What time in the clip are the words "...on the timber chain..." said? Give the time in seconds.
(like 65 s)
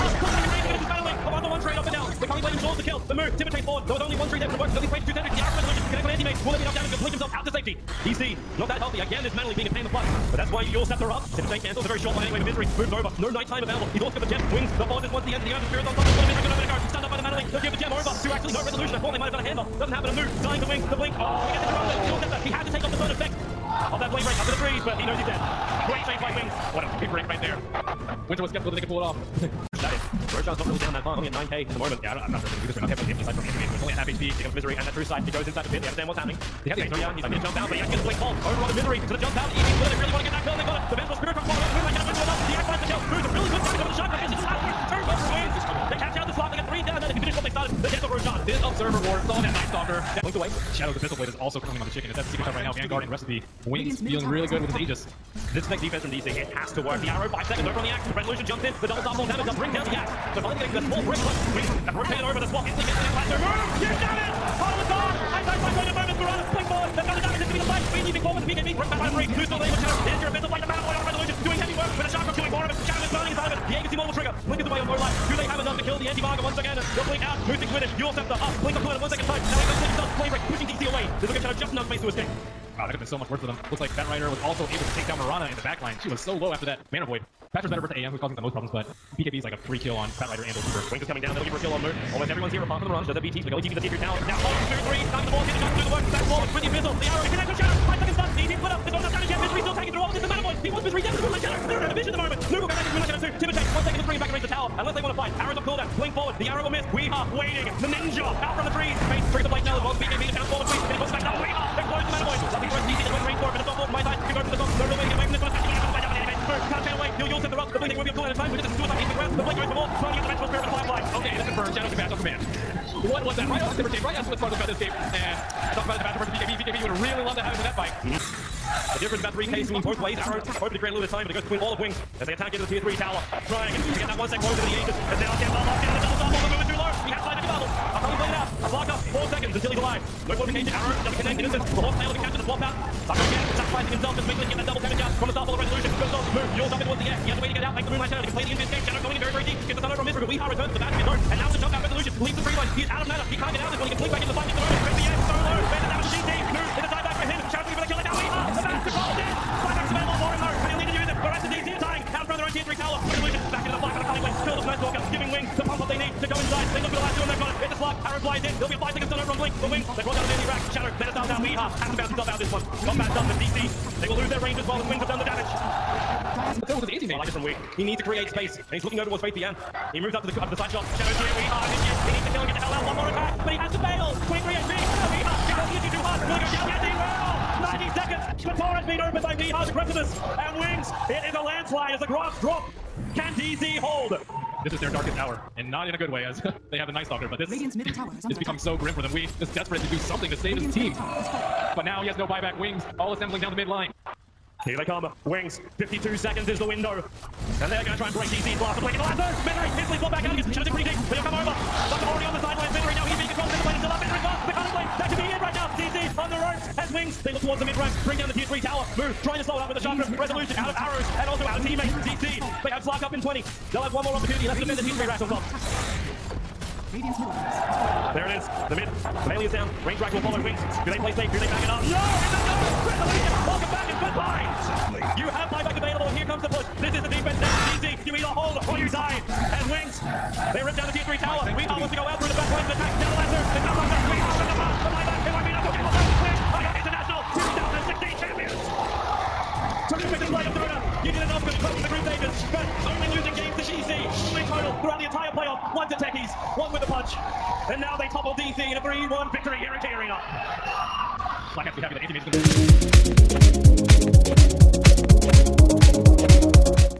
123 s.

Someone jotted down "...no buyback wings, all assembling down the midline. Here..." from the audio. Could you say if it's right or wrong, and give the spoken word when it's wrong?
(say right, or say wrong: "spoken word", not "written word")
right.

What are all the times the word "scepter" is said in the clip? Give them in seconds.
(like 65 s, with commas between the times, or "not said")
78 s.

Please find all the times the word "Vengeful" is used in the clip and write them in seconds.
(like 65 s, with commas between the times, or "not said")
40 s, 120 s.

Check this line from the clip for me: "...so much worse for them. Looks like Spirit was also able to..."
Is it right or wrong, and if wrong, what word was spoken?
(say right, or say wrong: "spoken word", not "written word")
wrong: "Batrider", not "Spirit".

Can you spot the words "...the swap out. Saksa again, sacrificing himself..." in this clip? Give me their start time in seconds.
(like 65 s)
142 s.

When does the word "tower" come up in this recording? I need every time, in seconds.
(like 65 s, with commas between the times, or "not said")
94 s, 104 s, 132 s, 162 s, 197 s, 218 s, 241 s.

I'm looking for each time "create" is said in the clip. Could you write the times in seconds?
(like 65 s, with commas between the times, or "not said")
130 s, 178 s.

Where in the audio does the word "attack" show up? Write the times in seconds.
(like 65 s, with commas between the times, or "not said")
132 s, 183 s, 198 s, 242 s.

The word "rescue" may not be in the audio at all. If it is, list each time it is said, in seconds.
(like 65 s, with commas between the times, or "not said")
not said.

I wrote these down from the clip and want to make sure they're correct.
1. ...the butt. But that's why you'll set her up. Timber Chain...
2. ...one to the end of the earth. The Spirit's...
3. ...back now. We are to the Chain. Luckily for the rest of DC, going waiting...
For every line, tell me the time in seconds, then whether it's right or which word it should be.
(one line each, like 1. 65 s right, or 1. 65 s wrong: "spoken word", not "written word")
1. 9 s right
2. 15 s right
3. 111 s wrong: "Matamoid", not "Chain".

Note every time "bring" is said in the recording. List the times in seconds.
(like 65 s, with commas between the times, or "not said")
59 s, 104 s, 218 s.